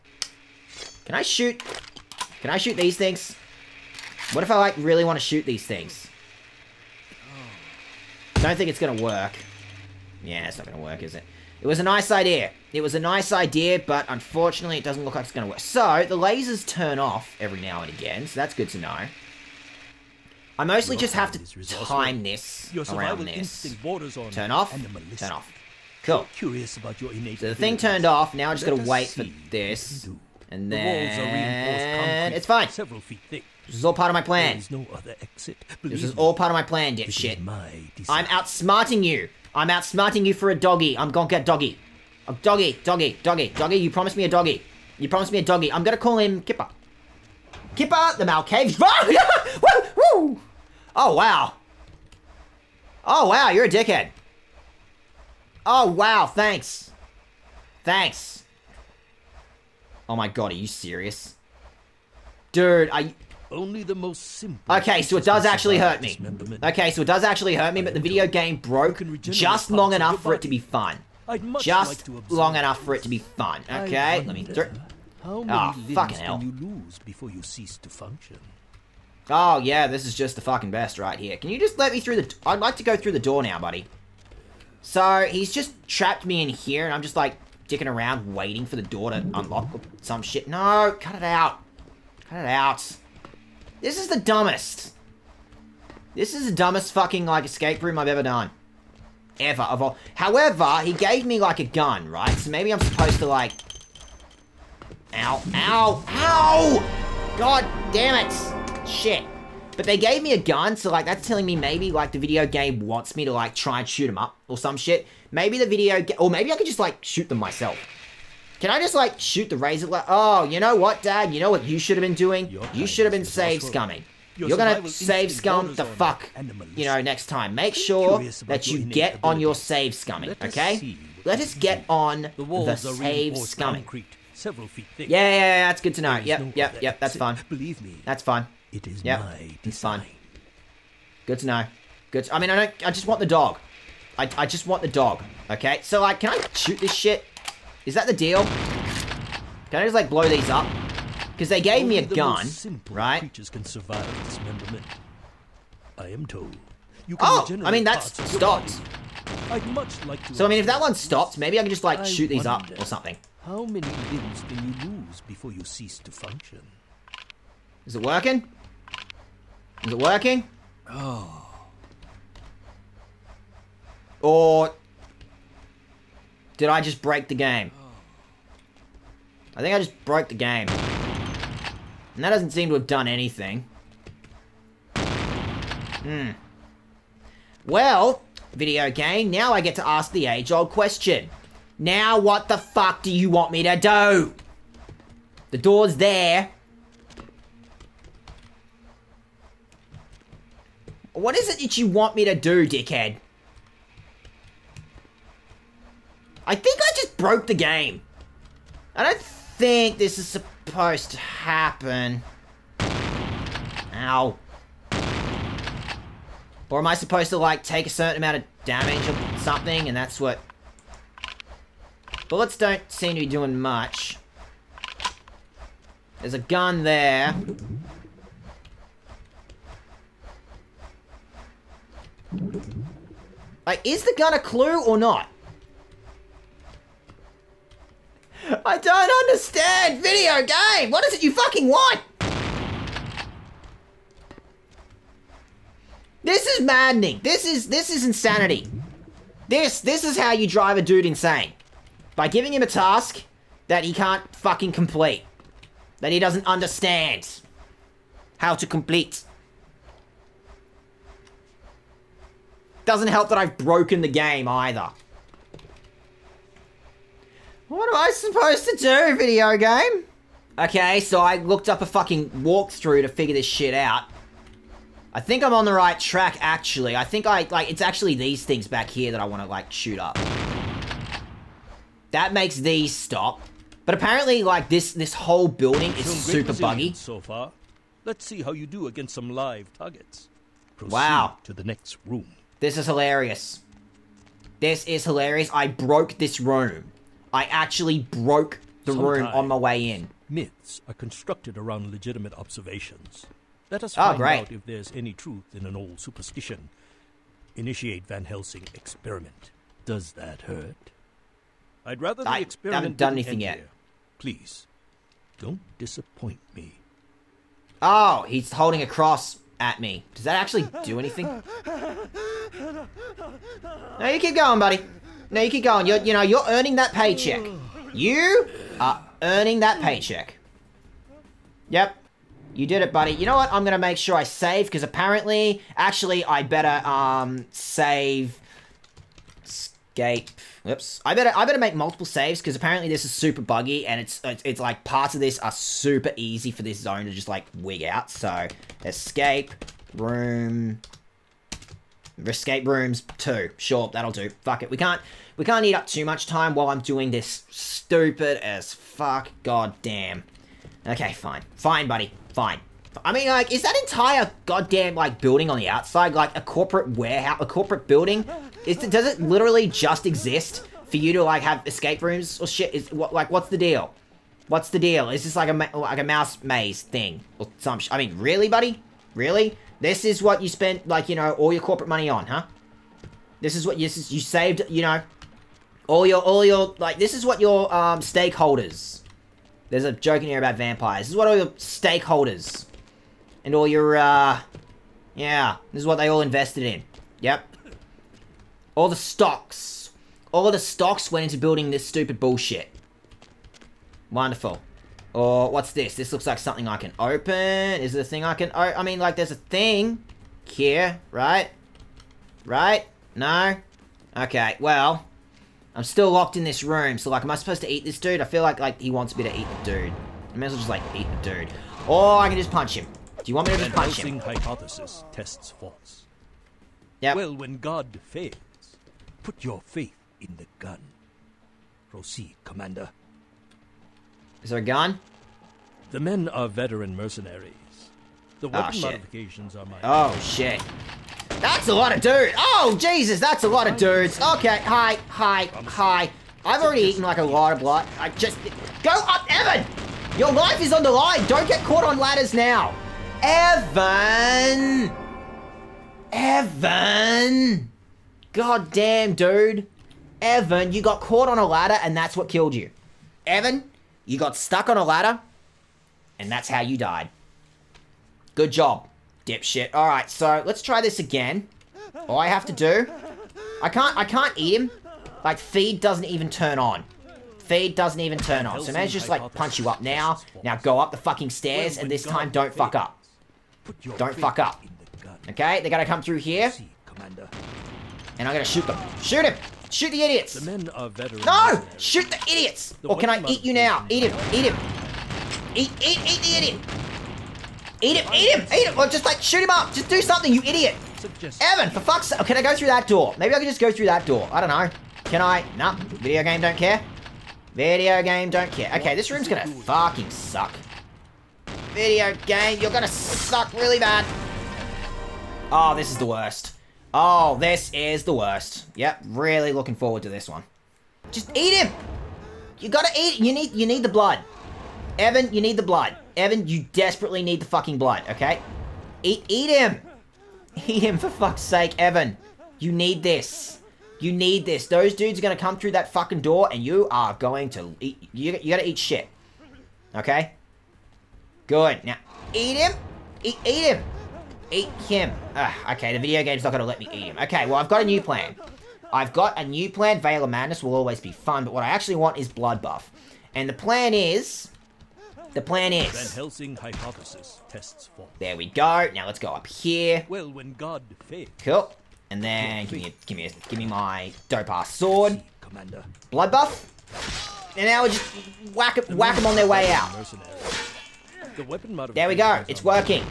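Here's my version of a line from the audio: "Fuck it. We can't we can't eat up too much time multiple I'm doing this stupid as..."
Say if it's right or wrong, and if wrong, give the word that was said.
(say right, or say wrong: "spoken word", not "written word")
wrong: "while", not "multiple".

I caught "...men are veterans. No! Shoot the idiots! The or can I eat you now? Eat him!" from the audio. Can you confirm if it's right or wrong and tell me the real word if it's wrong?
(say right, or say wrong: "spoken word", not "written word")
right.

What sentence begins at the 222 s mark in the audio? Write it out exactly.
Bullets don't seem to be doing much.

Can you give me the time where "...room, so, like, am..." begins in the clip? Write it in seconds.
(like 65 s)
416 s.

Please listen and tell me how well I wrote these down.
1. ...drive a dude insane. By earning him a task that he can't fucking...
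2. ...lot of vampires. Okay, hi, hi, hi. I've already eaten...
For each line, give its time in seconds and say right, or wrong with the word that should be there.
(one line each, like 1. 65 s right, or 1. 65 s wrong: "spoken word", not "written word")
1. 250 s wrong: "giving", not "earning"
2. 443 s wrong: "dudes", not "vampires".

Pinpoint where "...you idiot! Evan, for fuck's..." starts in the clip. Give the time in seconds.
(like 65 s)
500 s.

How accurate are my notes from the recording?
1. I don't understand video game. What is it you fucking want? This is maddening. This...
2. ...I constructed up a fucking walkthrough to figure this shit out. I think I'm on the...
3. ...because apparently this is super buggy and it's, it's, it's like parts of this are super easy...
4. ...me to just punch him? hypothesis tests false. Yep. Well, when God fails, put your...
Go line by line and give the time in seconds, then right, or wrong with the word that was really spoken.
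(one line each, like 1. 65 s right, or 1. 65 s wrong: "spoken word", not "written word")
1. 238 s right
2. 271 s wrong: "looked", not "constructed"
3. 342 s right
4. 423 s right.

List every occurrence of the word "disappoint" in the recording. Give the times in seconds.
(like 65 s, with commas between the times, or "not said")
315 s.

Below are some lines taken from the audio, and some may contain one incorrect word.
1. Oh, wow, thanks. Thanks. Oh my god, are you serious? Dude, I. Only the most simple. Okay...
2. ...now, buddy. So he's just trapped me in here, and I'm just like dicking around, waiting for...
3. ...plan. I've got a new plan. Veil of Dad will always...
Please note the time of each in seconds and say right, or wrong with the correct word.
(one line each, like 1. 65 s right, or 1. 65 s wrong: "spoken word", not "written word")
1. 55 s right
2. 83 s right
3. 548 s wrong: "Madness", not "Dad".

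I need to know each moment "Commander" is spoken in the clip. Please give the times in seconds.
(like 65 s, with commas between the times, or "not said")
432 s, 565 s.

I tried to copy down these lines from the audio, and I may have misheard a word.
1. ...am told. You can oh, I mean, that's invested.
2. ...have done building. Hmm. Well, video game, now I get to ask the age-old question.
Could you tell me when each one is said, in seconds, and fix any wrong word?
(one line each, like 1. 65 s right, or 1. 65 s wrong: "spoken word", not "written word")
1. 156 s wrong: "stopped", not "invested"
2. 182 s wrong: "anything", not "building".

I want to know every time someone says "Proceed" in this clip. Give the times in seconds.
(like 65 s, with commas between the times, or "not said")
290 s, 431 s.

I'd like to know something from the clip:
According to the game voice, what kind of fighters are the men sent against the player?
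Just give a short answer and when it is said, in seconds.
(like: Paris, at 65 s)
veteran mercenaries, at 436 s.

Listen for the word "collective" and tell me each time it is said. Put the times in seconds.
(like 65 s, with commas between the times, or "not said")
not said.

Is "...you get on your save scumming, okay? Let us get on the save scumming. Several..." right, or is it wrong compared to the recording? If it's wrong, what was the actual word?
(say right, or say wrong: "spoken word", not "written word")
right.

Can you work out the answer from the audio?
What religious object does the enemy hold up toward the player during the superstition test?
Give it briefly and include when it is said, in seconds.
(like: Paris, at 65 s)
a cross, at 318 s.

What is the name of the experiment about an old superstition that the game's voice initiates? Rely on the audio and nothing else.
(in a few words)
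Van Helsing experiment.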